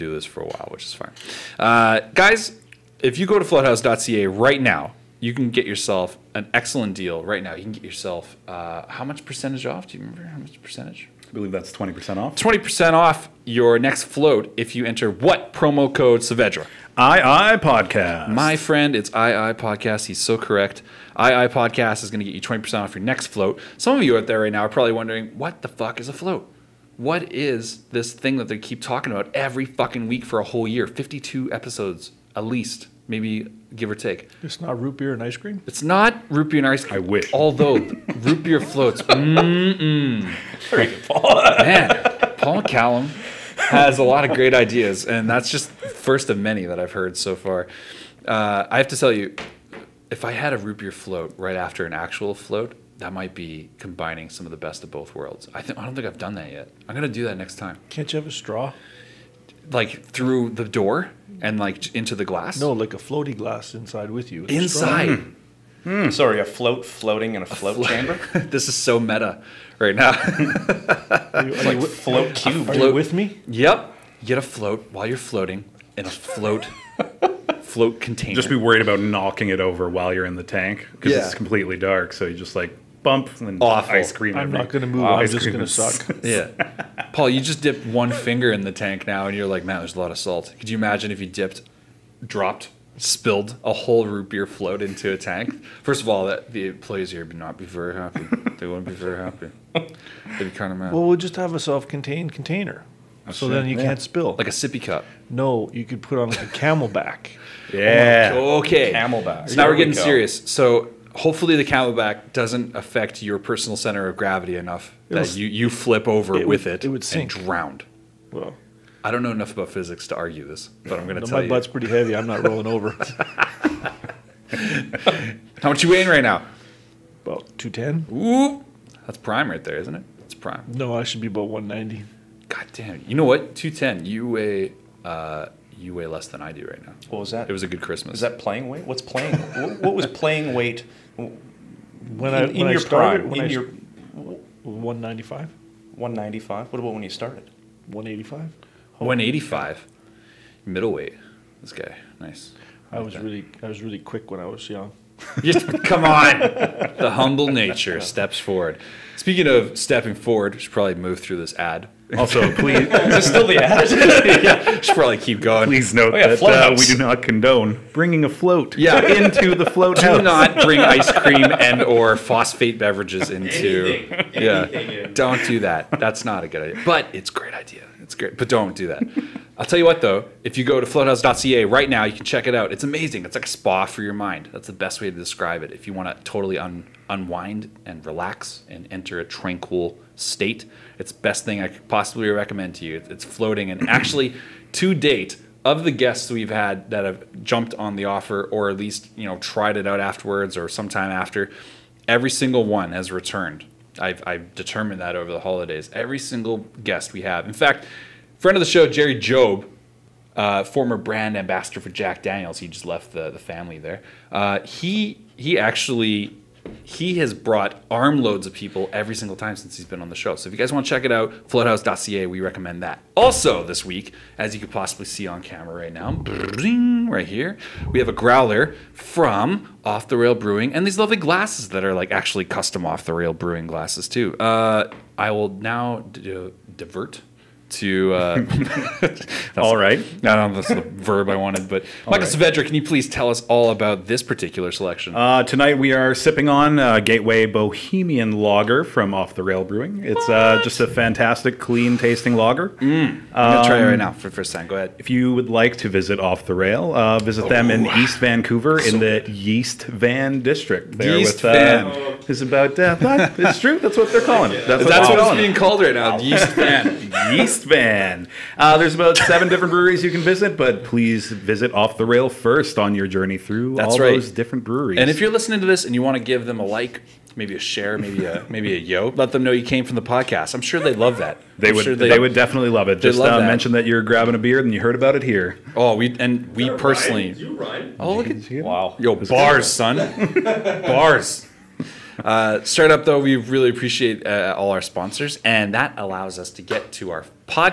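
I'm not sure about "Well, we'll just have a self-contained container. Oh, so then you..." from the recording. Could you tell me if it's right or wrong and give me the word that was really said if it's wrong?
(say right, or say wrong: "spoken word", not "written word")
right.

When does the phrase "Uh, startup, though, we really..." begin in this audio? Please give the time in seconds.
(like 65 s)
292 s.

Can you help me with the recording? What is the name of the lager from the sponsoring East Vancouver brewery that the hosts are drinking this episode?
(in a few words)
Gateway Bohemian Lager.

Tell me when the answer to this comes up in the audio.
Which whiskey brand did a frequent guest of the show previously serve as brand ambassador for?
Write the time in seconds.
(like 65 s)
211 s.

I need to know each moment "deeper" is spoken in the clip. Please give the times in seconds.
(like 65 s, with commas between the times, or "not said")
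not said.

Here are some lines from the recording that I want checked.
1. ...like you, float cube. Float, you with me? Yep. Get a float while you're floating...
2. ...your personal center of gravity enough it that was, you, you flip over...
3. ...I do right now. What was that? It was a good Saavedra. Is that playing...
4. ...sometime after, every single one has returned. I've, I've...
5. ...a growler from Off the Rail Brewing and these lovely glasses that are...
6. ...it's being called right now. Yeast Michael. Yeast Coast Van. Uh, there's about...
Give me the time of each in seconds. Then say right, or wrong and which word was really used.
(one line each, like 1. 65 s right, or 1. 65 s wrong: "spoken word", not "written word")
1. 71 s right
2. 113 s right
3. 136 s wrong: "Christmas", not "Saavedra"
4. 200 s right
5. 228 s right
6. 265 s wrong: "Van", not "Michael".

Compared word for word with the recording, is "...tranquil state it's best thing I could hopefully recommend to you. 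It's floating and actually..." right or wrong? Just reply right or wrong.
wrong.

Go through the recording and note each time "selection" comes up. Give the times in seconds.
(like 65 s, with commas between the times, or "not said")
244 s.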